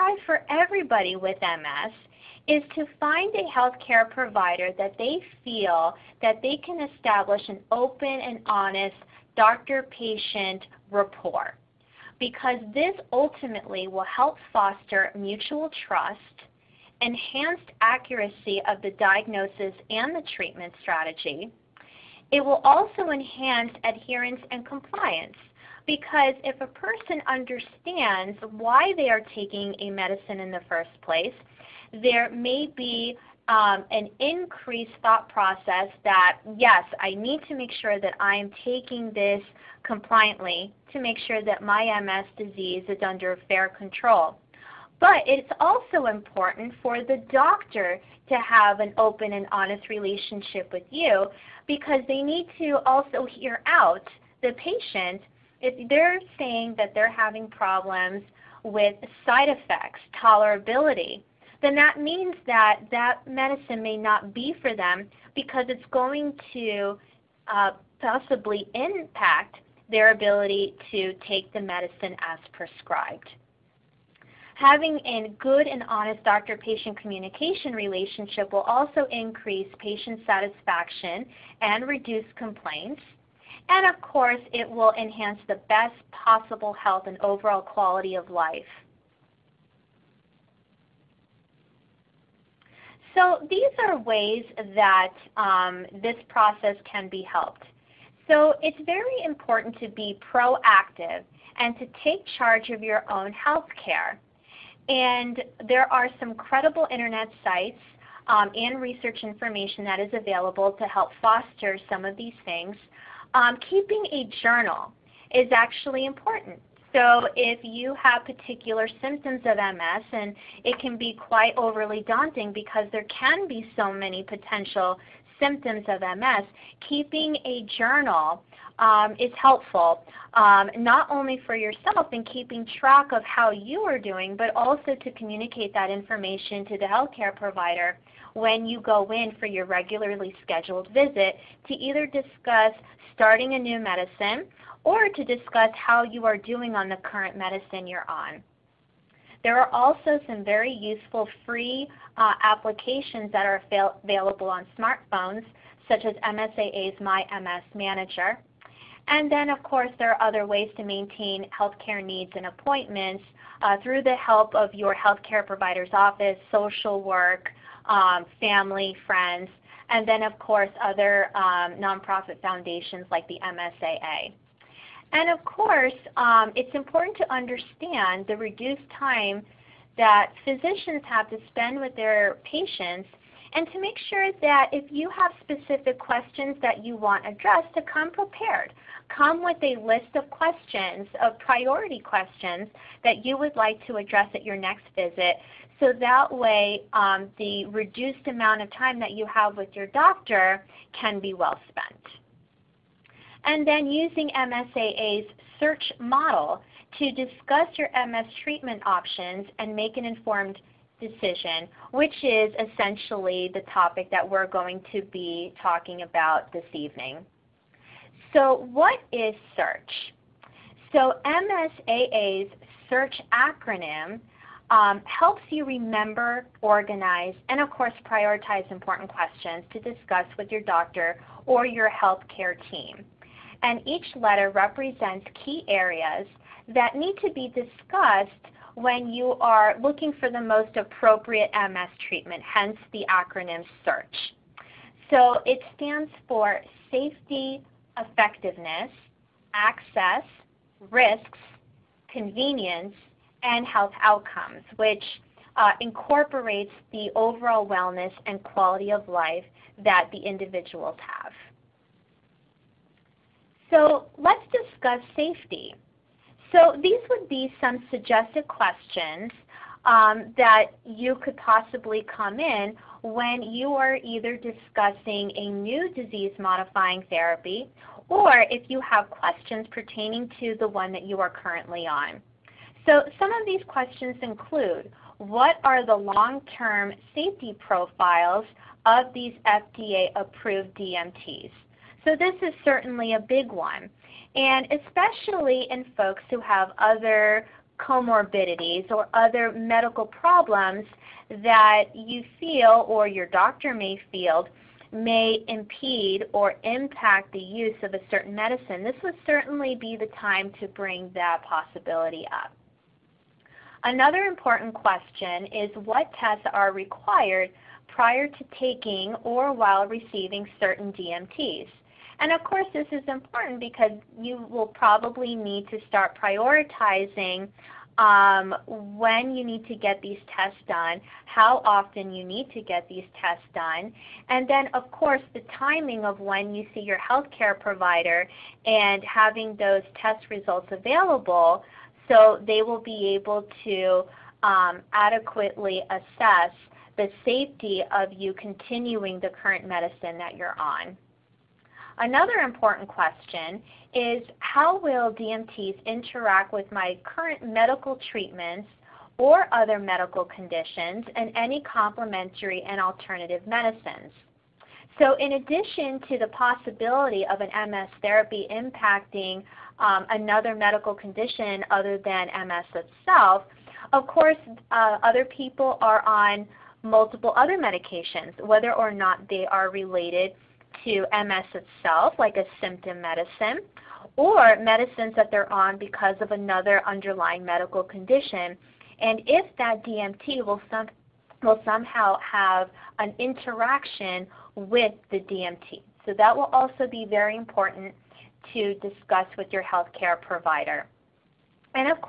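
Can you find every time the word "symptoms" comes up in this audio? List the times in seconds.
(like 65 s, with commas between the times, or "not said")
119 s, 125 s, 382 s.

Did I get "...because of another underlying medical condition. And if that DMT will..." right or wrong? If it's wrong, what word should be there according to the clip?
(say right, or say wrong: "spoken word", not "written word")
right.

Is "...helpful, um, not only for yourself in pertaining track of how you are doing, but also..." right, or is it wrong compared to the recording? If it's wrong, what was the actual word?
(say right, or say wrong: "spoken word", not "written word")
wrong: "keeping", not "pertaining".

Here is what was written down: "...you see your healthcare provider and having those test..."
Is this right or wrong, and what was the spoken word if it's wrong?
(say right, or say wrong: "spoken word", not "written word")
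right.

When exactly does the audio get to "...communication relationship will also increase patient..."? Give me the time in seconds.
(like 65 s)
76 s.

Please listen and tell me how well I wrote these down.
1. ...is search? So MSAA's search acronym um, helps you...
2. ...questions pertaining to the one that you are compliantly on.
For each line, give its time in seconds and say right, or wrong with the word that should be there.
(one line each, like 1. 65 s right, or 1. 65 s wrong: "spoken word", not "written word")
1. 219 s right
2. 279 s wrong: "currently", not "compliantly".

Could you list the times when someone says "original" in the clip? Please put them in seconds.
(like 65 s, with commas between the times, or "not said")
not said.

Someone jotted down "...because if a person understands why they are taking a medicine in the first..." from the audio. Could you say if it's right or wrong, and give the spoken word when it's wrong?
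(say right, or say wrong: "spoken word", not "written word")
right.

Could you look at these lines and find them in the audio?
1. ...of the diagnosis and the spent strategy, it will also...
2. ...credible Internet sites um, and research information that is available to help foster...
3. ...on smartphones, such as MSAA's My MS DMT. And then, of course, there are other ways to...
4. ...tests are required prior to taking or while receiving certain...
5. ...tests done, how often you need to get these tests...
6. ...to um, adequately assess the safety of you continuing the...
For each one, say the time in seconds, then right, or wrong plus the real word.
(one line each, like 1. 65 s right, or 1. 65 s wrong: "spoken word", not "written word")
1. 18 s wrong: "treatment", not "spent"
2. 106 s right
3. 154 s wrong: "Manager", not "DMT"
4. 316 s right
5. 330 s right
6. 343 s right.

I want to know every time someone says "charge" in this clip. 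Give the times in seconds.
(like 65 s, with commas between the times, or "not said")
102 s.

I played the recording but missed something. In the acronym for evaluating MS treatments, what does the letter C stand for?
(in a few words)
Convenience.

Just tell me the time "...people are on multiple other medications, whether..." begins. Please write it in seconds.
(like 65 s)
375 s.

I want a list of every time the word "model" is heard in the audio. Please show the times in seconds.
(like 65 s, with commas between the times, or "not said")
205 s.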